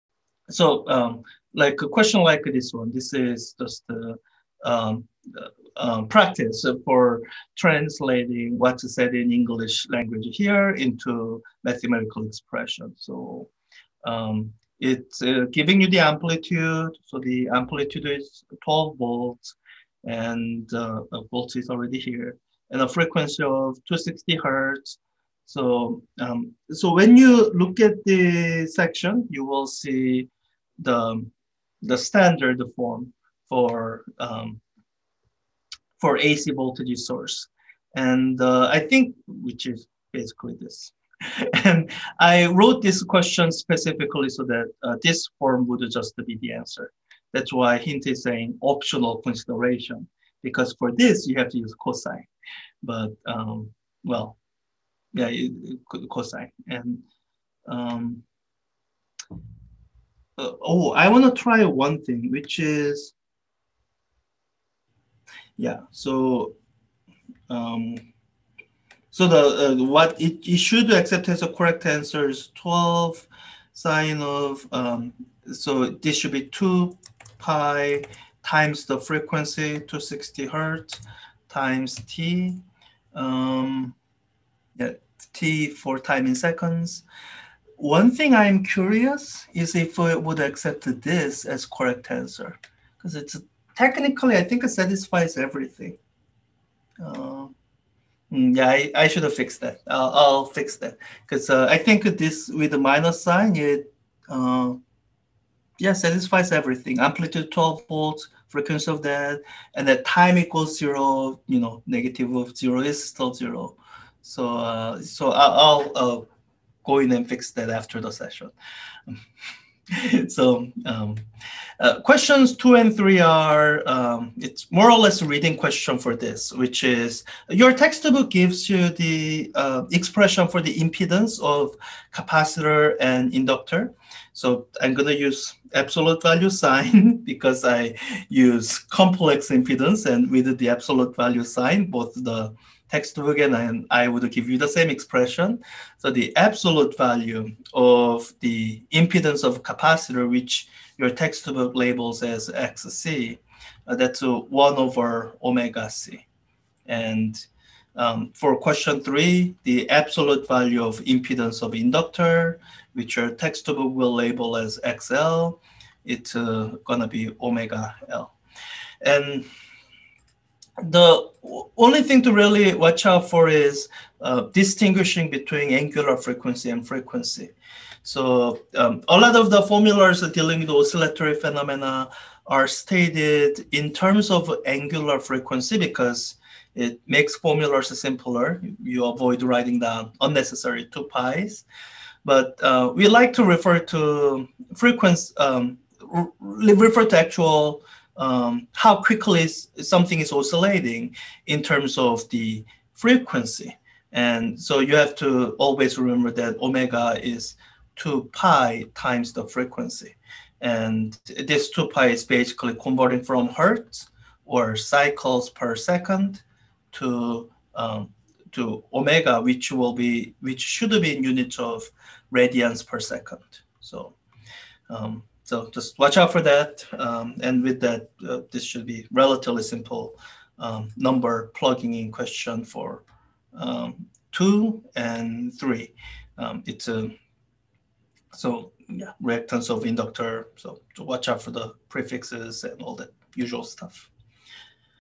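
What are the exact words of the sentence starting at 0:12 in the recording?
So um, it's uh, giving you the amplitude.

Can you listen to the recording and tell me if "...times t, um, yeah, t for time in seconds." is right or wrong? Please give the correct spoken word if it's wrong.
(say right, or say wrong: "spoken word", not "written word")
right.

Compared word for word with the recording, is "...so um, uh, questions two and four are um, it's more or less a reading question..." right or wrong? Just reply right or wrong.
wrong.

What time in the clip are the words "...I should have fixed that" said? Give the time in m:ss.
1:38.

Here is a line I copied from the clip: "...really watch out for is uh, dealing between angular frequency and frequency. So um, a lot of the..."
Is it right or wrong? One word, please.
wrong.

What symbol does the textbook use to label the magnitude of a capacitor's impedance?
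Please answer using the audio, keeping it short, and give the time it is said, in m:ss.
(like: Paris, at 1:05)
XC, at 2:32.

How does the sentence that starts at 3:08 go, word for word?
You avoid writing down unnecessary 2 pi's.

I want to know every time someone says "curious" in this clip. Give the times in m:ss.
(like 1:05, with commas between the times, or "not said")
1:28.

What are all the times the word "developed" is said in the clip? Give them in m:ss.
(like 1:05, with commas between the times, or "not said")
not said.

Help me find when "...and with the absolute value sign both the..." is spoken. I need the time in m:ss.
2:20.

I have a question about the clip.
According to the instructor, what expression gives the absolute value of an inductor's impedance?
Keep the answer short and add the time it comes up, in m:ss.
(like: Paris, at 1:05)
omega L, at 2:47.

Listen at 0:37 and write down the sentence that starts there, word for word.
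And uh, I think, which is basically this.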